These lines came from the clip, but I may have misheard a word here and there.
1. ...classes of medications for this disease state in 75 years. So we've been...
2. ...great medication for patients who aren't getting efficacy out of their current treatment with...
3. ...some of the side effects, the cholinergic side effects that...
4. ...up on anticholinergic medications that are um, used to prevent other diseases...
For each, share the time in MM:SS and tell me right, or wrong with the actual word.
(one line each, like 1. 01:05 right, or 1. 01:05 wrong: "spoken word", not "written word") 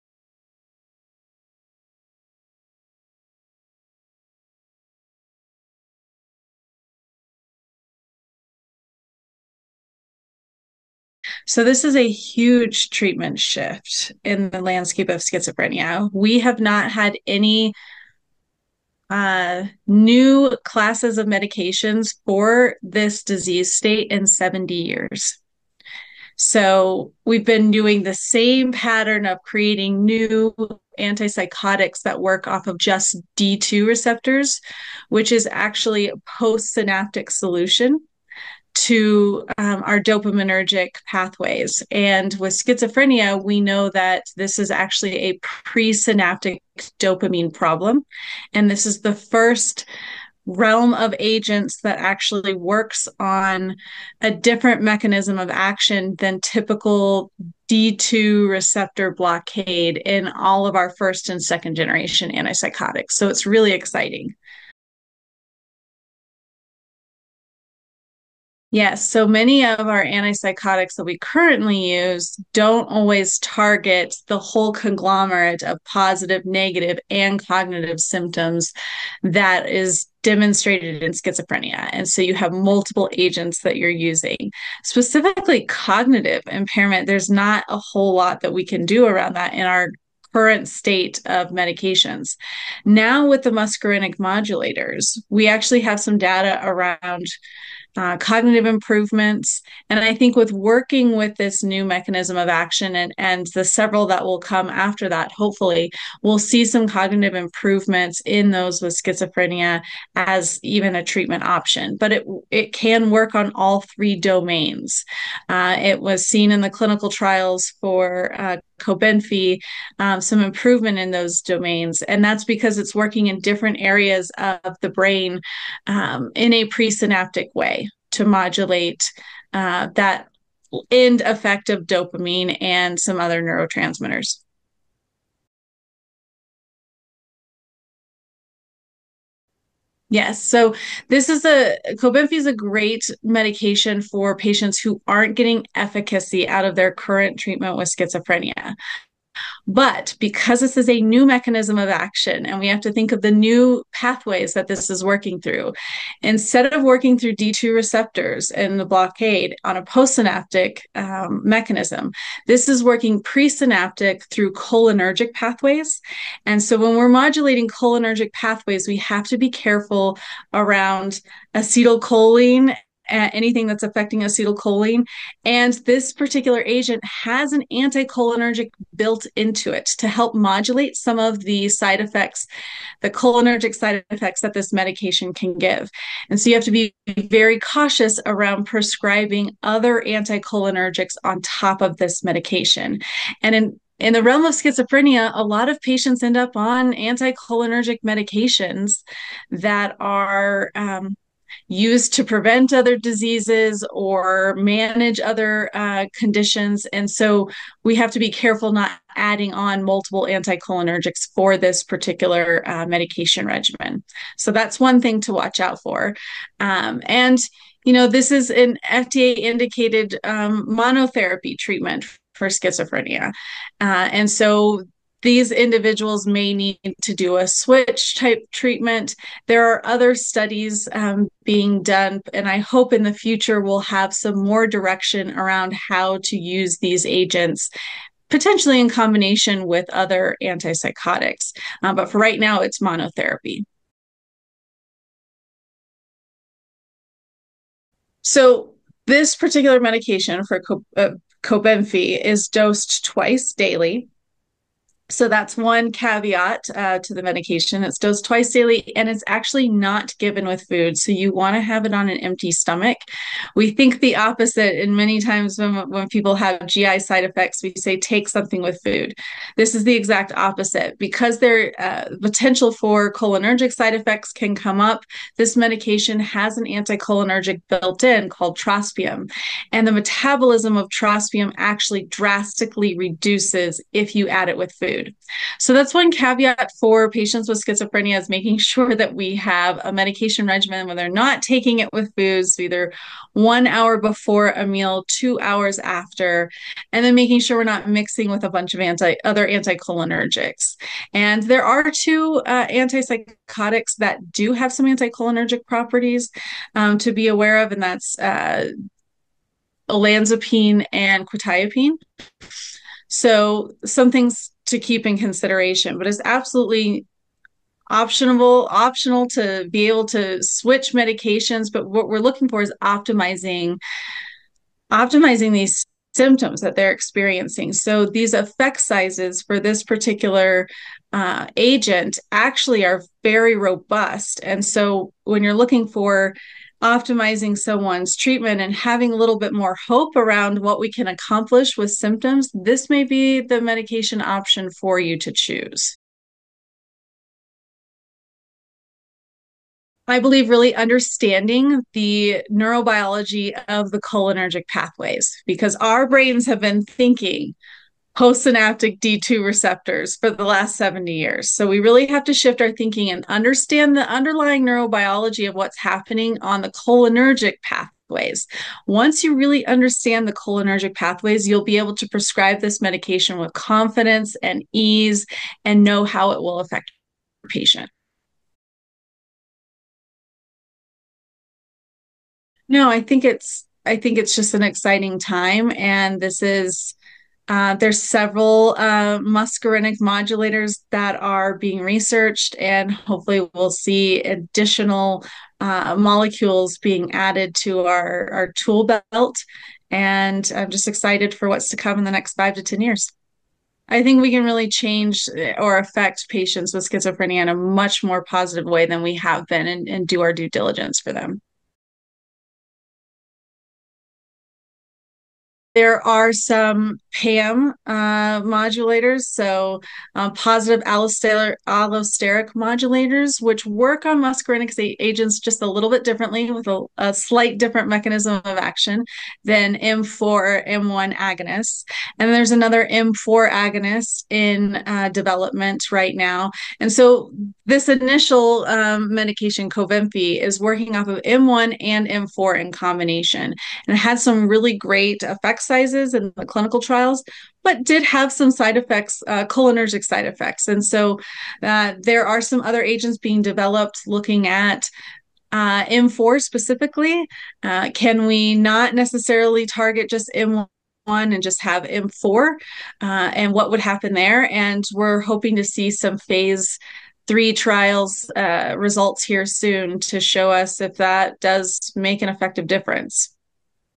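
1. 00:20 wrong: "70", not "75"
2. 02:22 right
3. 03:00 right
4. 03:16 right.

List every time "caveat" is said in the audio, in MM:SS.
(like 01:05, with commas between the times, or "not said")
04:15, 04:46.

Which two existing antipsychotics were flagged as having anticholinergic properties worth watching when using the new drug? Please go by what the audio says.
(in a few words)
olanzapine and quetiapine.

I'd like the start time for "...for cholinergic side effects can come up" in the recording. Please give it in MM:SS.
04:32.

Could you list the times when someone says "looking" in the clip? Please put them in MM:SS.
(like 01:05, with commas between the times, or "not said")
05:22, 05:35, 07:34.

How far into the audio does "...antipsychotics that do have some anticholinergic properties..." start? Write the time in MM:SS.
05:02.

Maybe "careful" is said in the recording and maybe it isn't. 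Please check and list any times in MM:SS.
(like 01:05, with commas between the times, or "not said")
02:49, 03:28.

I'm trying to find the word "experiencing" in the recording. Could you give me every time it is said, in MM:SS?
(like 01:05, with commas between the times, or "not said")
05:26.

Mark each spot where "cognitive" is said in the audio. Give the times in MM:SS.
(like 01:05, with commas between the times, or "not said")
01:17, 01:25, 01:38, 01:46.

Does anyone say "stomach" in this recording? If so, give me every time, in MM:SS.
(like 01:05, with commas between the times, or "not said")
04:22.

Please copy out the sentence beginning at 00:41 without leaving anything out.
And with schizophrenia, we know that this is actually a presynaptic dopamine problem.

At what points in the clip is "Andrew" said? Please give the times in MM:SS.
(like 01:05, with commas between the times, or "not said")
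not said.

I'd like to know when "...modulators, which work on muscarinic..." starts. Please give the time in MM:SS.
07:02.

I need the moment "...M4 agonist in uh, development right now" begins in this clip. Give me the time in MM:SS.
07:12.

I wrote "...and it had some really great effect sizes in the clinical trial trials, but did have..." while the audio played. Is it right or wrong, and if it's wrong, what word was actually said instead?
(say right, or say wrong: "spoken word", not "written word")
right.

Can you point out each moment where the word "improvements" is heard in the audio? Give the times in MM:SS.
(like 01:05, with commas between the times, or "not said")
01:38, 01:47, 02:00.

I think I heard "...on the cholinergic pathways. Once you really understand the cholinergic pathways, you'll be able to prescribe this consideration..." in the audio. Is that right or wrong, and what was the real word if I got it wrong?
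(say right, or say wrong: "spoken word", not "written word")
wrong: "medication", not "consideration".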